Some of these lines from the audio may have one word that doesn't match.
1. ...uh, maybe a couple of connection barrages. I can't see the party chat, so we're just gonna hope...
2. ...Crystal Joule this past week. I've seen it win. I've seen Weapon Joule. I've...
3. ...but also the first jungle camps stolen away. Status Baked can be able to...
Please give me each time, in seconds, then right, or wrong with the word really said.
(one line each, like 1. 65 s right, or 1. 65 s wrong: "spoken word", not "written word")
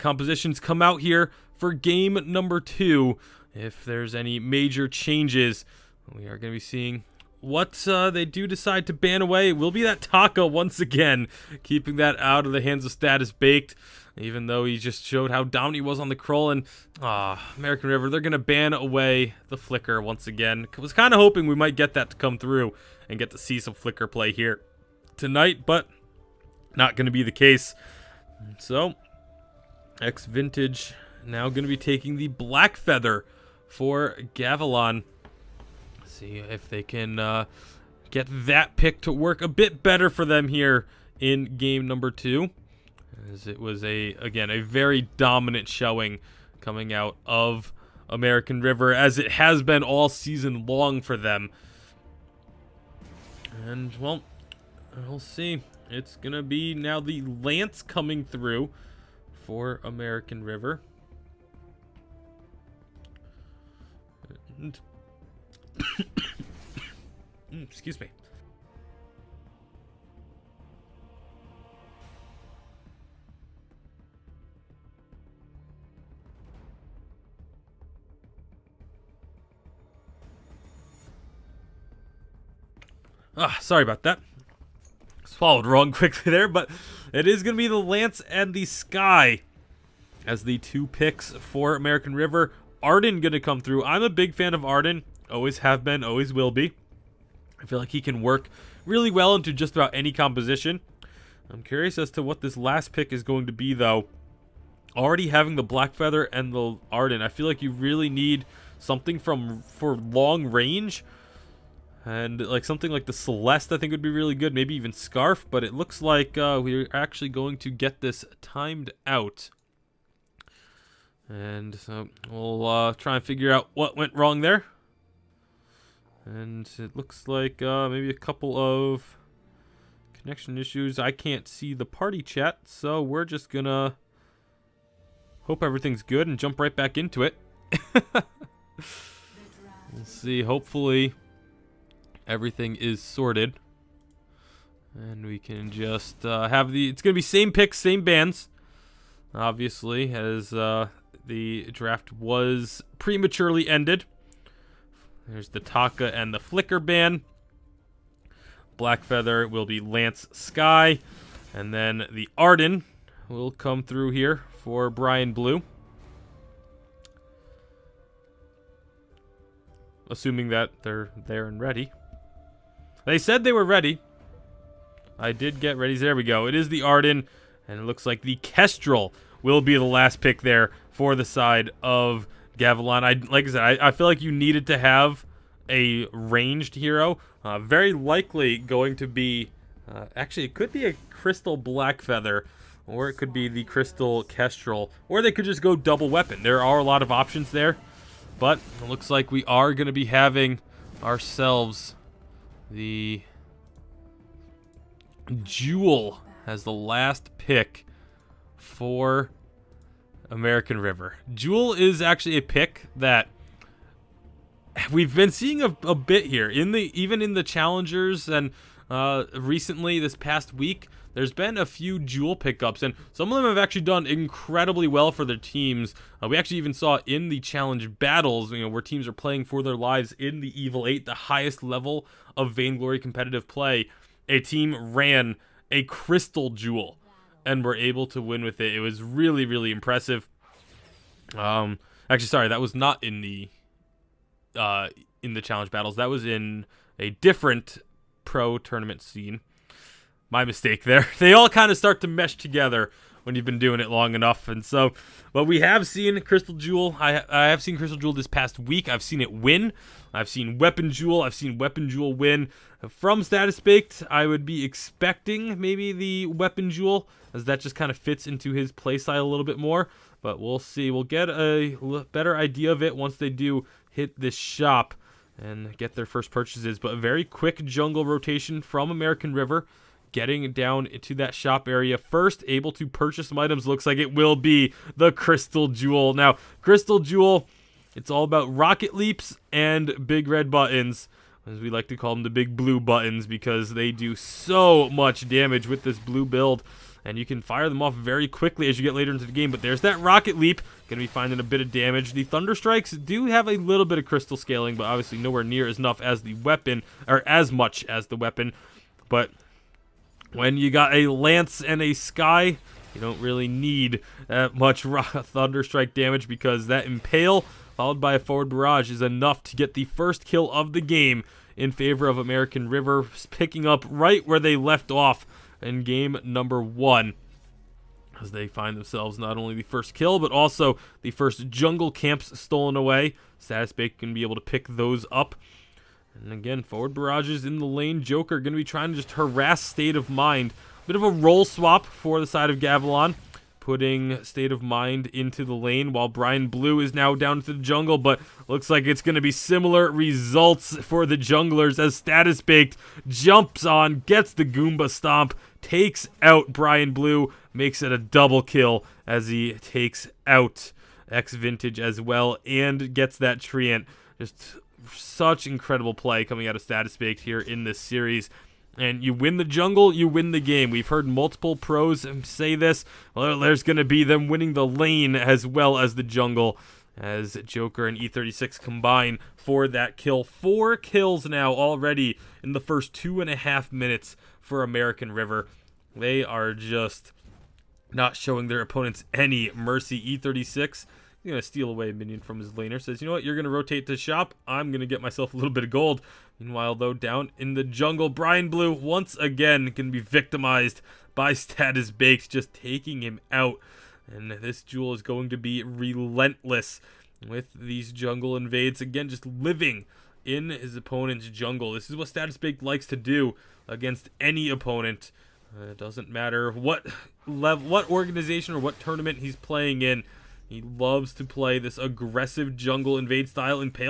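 1. 127 s wrong: "issues", not "barrages"
2. 257 s right
3. 330 s right.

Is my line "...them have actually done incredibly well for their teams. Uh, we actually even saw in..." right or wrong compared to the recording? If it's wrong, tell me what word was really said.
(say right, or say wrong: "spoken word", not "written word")
right.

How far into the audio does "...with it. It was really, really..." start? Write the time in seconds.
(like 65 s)
238 s.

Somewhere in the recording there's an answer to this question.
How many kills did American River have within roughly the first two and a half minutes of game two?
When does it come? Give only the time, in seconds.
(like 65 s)
380 s.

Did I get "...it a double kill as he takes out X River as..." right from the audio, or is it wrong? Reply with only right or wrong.
wrong.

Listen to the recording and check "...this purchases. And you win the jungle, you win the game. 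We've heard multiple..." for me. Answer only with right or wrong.
wrong.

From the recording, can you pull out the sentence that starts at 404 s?
And this Joule is going to be relentless with these jungle invades.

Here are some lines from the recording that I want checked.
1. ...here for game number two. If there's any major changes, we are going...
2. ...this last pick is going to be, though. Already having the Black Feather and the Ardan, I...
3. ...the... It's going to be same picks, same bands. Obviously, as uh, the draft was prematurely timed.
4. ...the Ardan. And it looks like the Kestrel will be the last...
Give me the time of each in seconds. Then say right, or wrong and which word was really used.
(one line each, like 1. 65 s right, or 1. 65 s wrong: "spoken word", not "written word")
1. 1 s right
2. 102 s right
3. 146 s wrong: "ended", not "timed"
4. 176 s right.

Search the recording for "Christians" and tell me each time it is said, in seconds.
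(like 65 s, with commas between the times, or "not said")
not said.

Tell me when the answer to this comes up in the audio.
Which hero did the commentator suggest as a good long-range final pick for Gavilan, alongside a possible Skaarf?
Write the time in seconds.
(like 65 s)
113 s.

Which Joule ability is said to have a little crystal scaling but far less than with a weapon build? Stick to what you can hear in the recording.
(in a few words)
Thunder strikes.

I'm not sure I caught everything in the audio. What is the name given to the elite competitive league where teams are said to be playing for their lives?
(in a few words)
Evil Eight.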